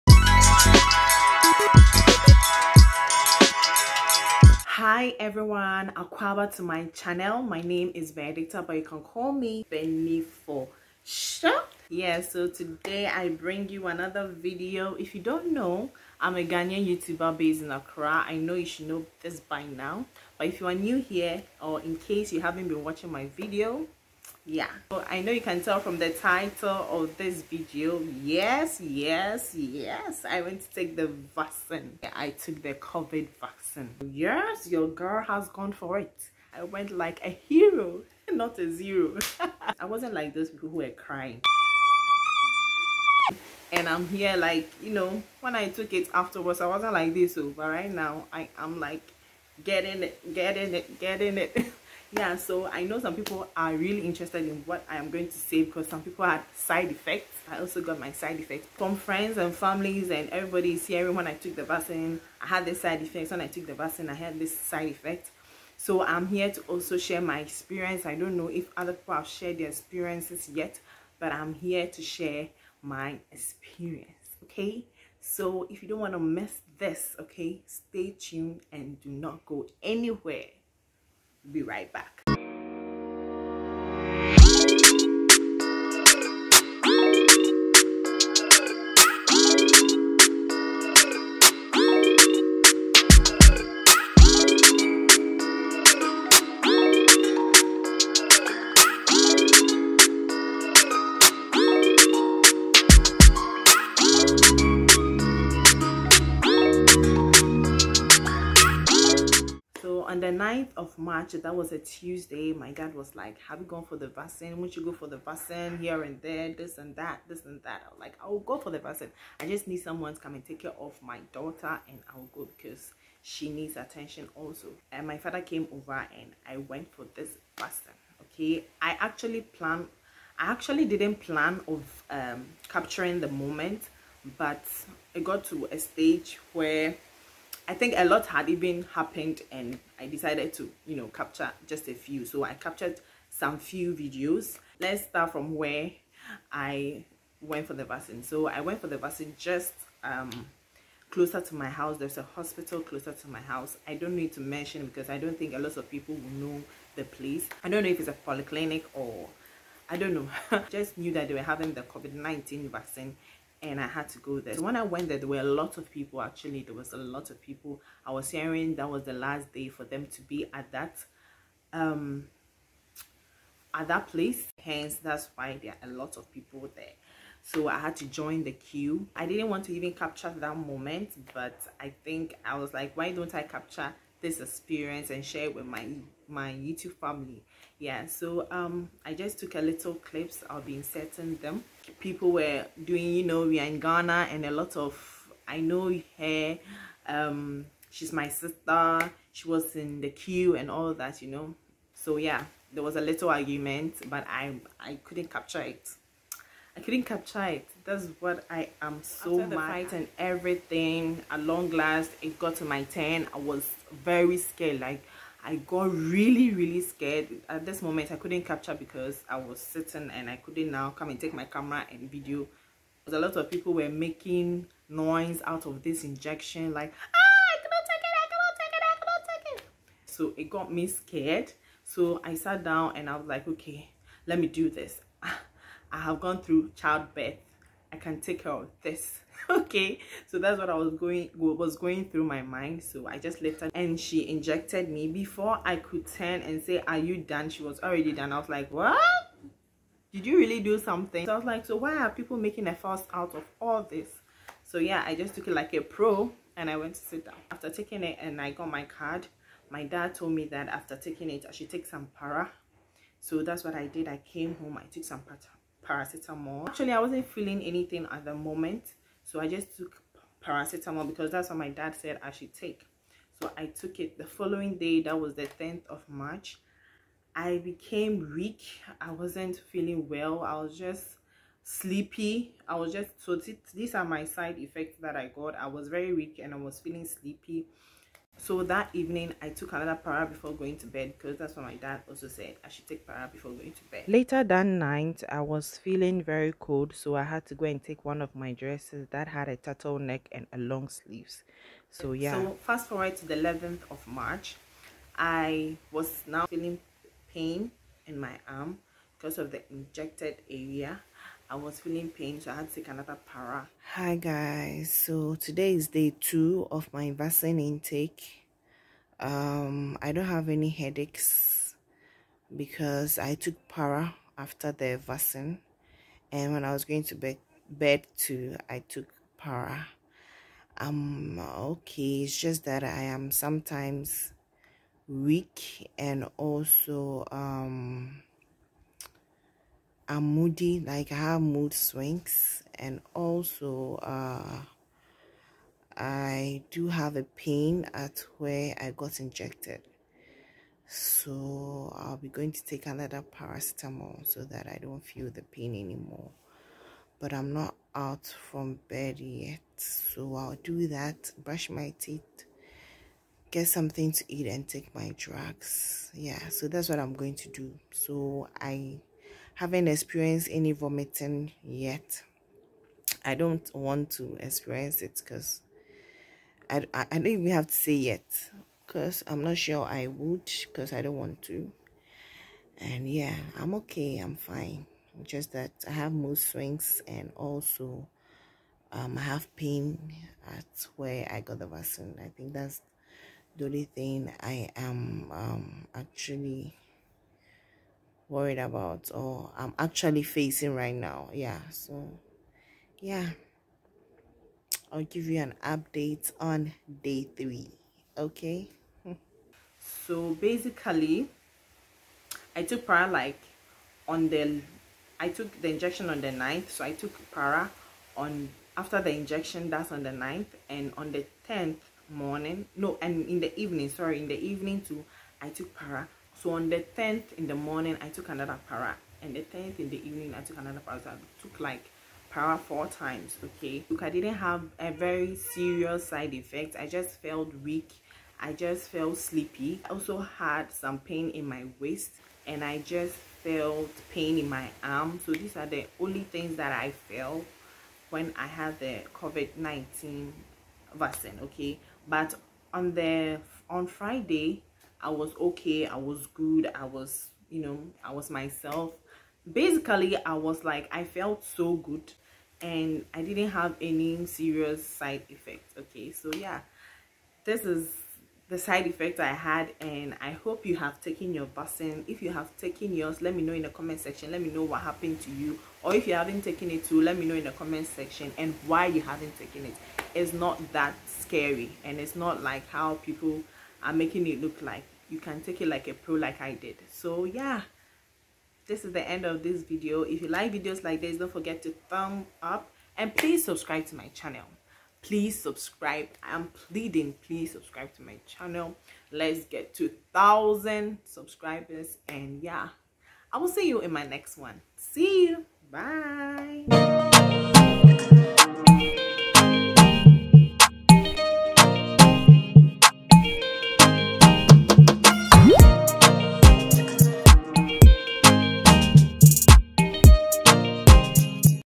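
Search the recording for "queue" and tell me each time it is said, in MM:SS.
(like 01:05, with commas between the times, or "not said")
02:58, 03:20.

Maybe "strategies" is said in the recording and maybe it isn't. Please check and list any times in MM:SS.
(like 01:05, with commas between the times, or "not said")
not said.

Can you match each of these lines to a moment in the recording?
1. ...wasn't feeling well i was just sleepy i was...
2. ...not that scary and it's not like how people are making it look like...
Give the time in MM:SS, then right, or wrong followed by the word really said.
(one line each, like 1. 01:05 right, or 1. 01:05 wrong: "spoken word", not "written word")
1. 04:39 right
2. 08:00 right.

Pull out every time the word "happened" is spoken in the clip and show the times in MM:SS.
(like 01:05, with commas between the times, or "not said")
02:18, 07:54.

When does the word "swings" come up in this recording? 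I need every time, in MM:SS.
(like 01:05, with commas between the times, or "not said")
05:41, 06:26.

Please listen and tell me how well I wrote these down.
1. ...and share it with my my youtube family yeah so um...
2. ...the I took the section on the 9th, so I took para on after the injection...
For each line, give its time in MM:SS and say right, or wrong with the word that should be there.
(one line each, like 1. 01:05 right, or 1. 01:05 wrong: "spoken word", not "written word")
1. 03:05 right
2. 06:54 wrong: "injection", not "section".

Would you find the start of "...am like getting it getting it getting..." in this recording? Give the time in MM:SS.
00:48.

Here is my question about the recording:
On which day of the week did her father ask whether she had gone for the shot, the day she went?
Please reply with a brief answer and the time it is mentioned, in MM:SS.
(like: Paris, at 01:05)
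Tuesday, at 01:51.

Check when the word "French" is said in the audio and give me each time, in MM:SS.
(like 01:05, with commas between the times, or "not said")
not said.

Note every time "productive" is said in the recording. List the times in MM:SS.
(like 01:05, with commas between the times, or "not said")
not said.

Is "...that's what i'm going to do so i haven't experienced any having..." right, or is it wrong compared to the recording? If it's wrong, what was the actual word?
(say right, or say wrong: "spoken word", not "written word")
wrong: "vomiting", not "having".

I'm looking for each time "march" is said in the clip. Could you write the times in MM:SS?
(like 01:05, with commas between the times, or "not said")
01:50, 04:36, 05:04.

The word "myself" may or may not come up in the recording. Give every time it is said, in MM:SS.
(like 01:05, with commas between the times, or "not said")
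07:38.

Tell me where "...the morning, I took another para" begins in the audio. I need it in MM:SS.
07:07.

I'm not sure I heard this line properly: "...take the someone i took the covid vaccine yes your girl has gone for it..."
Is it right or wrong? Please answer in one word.
wrong.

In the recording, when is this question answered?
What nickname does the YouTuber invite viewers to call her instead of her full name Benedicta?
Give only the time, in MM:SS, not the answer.
00:09.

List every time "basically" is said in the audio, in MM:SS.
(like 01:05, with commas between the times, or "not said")
06:50, 07:39.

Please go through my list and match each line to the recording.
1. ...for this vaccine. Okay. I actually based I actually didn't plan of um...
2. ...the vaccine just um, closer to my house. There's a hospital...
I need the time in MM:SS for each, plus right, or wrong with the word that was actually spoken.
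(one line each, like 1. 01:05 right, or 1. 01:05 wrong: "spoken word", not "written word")
1. 02:06 wrong: "planned", not "based"
2. 02:28 right.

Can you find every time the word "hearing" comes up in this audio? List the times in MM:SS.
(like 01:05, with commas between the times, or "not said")
01:00, 02:48.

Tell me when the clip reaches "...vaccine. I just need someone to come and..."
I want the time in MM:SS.
01:58.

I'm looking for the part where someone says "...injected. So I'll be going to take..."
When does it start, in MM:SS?
05:49.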